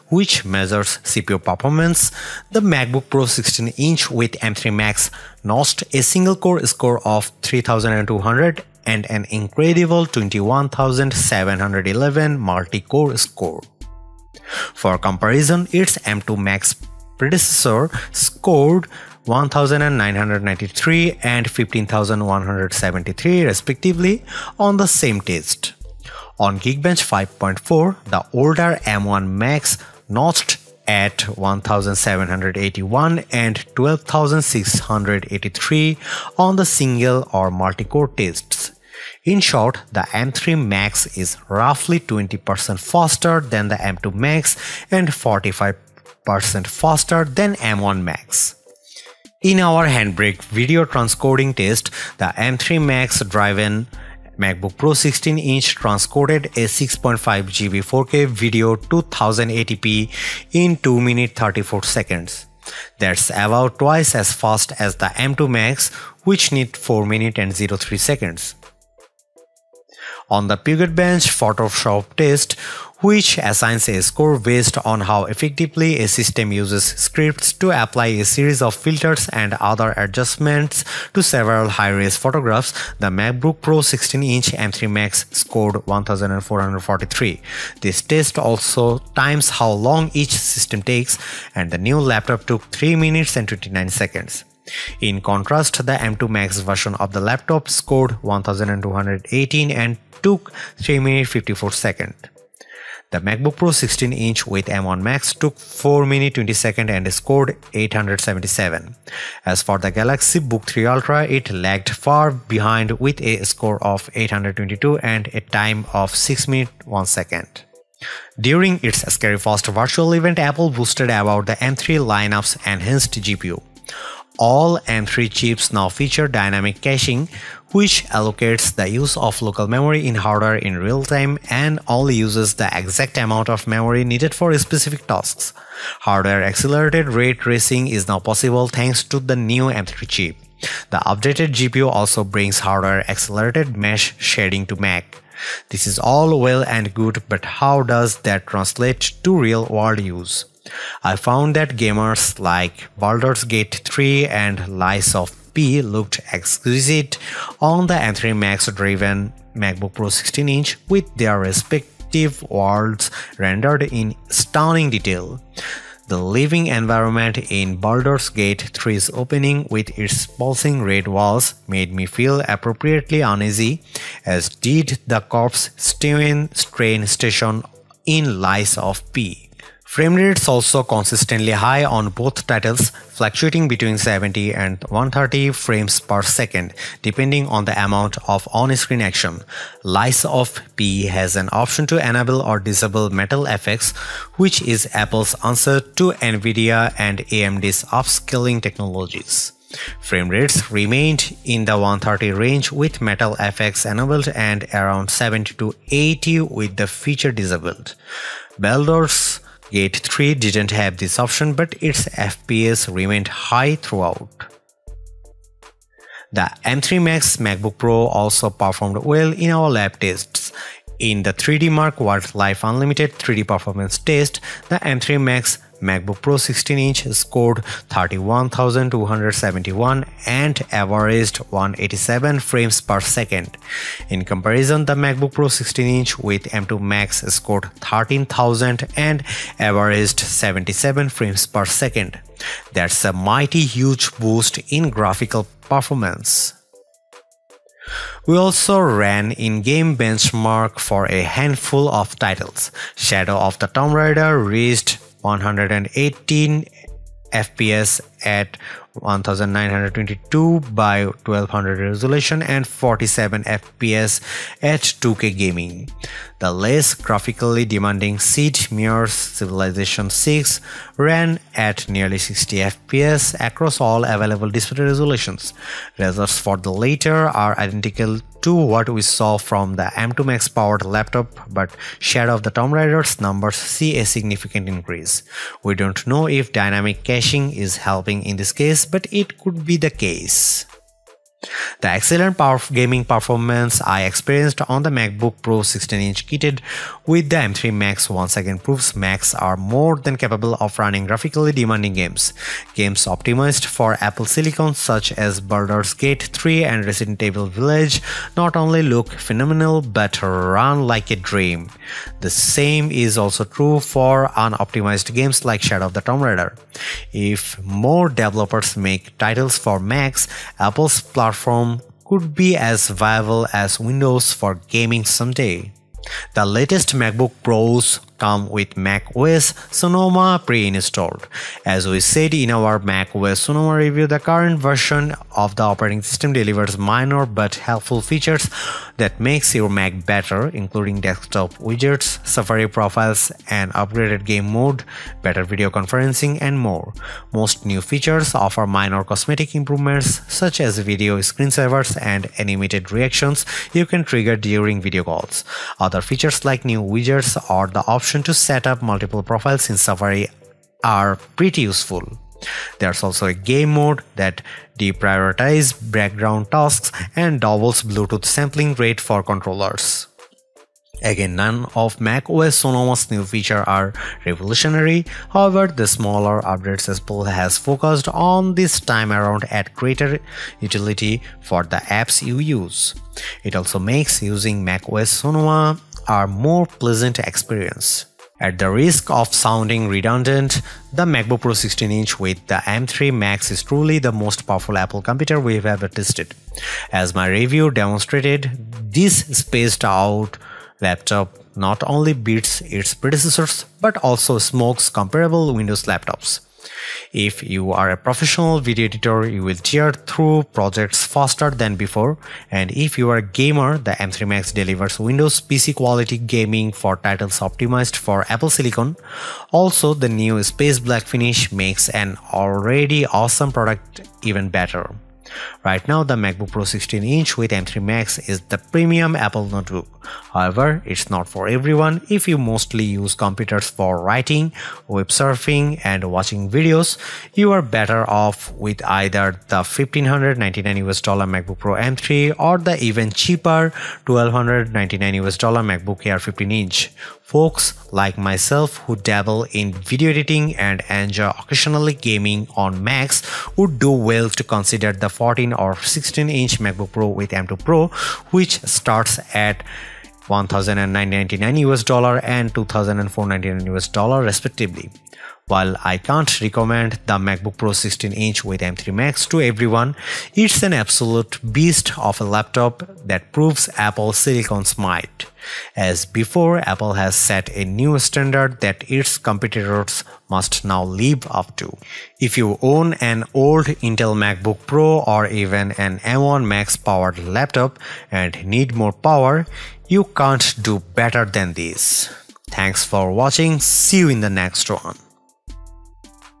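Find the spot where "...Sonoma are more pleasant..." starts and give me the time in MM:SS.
06:25.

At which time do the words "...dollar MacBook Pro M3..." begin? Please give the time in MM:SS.
07:20.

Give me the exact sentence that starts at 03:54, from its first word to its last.
In comparison, the MacBook Pro 16 inch with M2 Max scored 13,000 and averaged 77 frames per second.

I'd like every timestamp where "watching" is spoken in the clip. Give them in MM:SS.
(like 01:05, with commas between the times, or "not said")
07:16, 08:13.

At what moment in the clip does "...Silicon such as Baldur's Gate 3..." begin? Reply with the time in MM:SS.
05:04.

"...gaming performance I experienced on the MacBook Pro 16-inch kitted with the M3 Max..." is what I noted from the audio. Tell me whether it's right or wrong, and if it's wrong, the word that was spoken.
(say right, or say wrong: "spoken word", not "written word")
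right.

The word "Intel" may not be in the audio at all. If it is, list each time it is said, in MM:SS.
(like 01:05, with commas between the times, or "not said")
08:03.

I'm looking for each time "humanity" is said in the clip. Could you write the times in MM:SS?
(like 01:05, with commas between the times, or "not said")
not said.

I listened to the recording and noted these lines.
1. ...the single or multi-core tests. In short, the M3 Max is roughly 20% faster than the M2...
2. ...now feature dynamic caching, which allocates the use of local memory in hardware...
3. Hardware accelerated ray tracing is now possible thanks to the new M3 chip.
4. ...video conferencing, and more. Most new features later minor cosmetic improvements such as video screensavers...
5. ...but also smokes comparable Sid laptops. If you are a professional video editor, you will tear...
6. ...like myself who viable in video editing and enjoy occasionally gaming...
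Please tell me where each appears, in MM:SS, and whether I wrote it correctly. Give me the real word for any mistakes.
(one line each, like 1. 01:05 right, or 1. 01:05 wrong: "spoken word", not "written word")
1. 00:36 right
2. 02:05 right
3. 02:15 right
4. 05:45 wrong: "offer", not "later"
5. 06:43 wrong: "Windows", not "Sid"
6. 07:27 wrong: "dabble", not "viable".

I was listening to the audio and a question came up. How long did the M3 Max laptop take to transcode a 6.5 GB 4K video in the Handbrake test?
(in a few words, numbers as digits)
2 minutes 34 seconds.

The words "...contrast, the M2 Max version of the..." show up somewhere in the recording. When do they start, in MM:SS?
01:35.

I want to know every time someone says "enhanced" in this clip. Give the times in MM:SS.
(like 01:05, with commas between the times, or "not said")
02:02.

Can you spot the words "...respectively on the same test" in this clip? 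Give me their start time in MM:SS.
00:23.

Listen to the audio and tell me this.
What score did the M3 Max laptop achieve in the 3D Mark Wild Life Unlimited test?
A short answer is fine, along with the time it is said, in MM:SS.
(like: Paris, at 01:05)
31,271, at 03:47.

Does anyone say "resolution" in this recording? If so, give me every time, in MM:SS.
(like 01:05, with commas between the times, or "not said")
04:21, 04:34.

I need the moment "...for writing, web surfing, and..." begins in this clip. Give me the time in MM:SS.
07:13.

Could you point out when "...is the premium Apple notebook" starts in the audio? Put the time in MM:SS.
07:08.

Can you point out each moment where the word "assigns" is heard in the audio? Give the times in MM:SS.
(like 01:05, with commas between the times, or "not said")
01:13.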